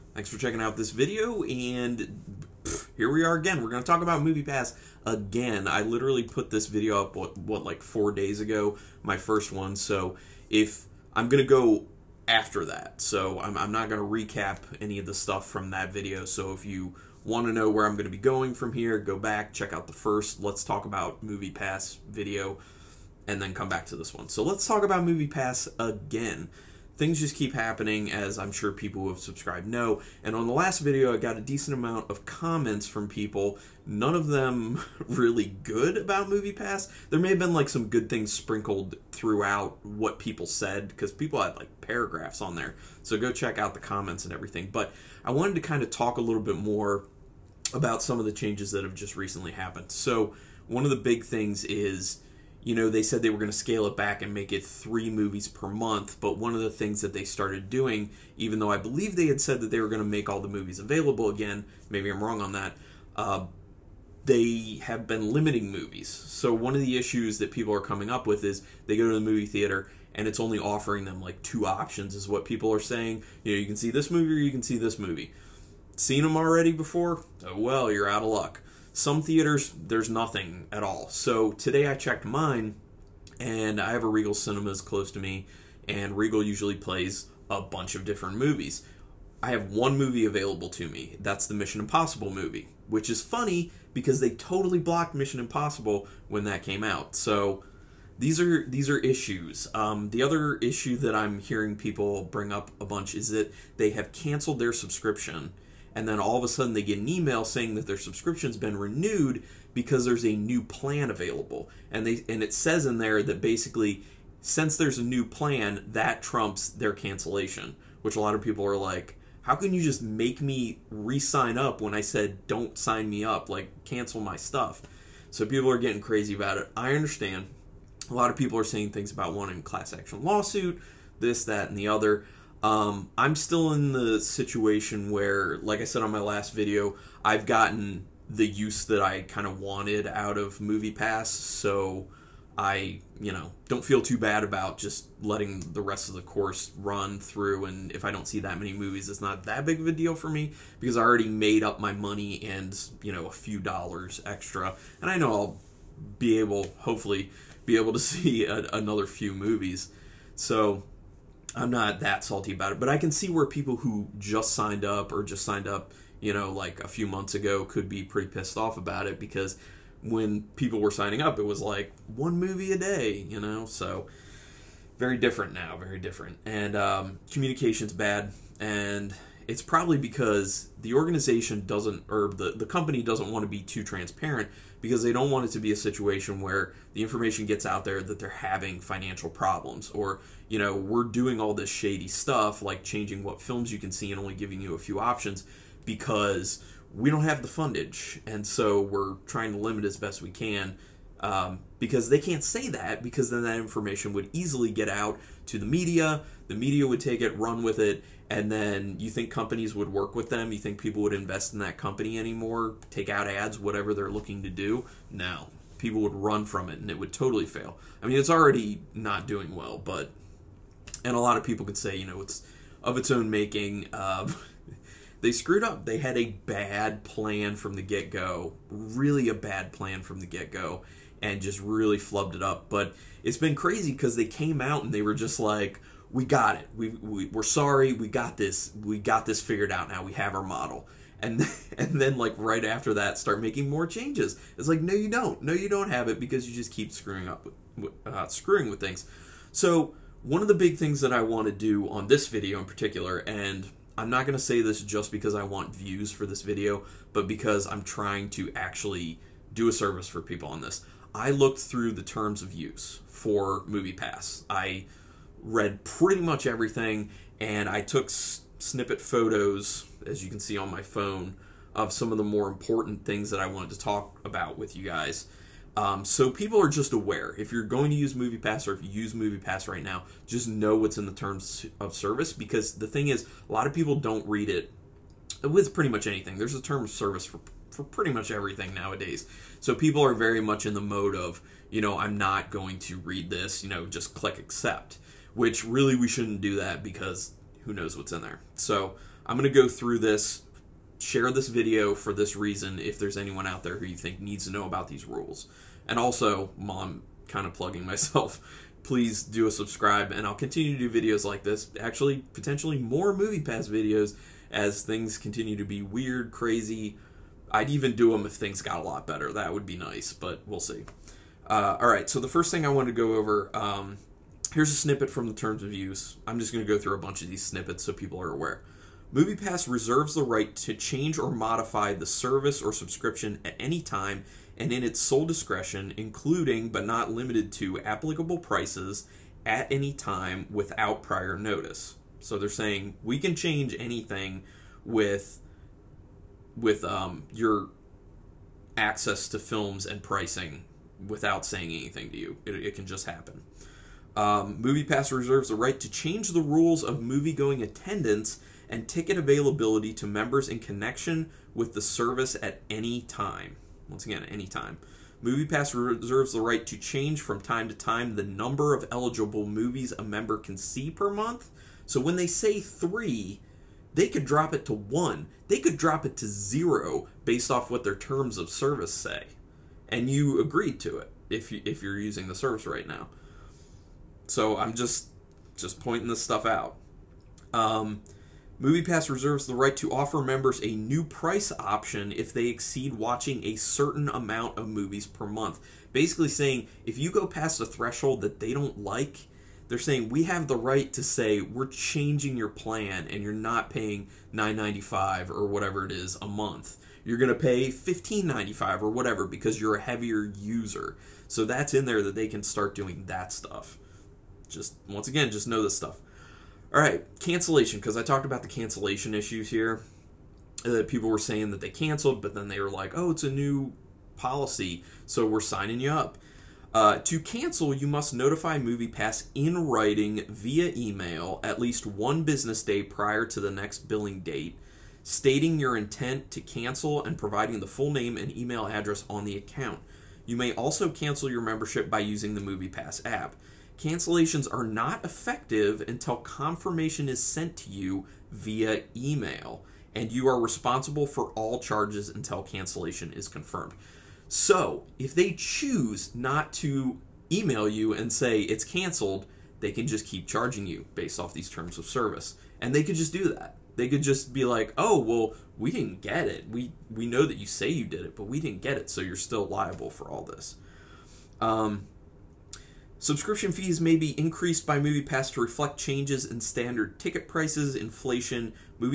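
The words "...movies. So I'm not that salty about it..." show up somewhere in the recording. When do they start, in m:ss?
2:39.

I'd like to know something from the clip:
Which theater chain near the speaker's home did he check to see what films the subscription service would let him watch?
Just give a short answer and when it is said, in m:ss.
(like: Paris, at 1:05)
Regal Cinemas, at 1:24.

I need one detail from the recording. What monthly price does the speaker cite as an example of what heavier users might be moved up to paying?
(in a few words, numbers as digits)
15.95.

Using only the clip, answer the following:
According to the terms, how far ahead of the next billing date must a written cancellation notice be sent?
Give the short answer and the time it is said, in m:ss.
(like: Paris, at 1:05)
1 business day, at 7:11.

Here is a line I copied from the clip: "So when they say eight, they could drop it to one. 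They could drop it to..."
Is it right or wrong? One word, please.
wrong.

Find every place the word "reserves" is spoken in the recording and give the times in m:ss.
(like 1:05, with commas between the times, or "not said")
5:29, 5:55, 6:05, 6:29.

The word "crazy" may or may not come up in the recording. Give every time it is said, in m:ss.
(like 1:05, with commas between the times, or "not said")
2:06, 3:53, 5:16.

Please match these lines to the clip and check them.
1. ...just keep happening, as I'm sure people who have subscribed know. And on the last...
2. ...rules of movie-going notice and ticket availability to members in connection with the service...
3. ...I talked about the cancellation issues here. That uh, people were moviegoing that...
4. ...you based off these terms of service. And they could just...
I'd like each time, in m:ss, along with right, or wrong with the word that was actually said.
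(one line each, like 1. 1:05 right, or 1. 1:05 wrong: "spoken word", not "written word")
1. 0:27 right
2. 5:56 wrong: "attendance", not "notice"
3. 6:57 wrong: "saying", not "moviegoing"
4. 7:40 right.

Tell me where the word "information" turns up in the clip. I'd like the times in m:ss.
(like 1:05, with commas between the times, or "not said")
3:07, 3:23.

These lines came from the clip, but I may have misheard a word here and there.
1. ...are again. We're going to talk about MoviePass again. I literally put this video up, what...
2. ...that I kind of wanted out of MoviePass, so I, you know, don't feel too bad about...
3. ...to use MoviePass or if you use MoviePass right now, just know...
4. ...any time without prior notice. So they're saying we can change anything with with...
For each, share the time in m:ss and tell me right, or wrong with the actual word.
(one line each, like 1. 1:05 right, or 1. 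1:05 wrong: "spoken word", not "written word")
1. 0:03 right
2. 2:18 right
3. 4:37 right
4. 5:39 right.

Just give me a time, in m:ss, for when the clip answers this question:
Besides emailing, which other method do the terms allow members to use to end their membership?
7:22.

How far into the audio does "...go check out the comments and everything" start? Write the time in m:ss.
0:43.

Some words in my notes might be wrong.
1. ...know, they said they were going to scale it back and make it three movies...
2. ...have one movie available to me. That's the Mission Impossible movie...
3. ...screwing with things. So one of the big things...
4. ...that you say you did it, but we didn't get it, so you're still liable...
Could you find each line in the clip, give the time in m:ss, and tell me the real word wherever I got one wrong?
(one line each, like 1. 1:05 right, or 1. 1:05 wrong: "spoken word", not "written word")
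1. 0:52 right
2. 1:29 right
3. 4:08 right
4. 7:47 right.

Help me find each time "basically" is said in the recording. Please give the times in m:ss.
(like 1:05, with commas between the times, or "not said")
1:53, 6:35.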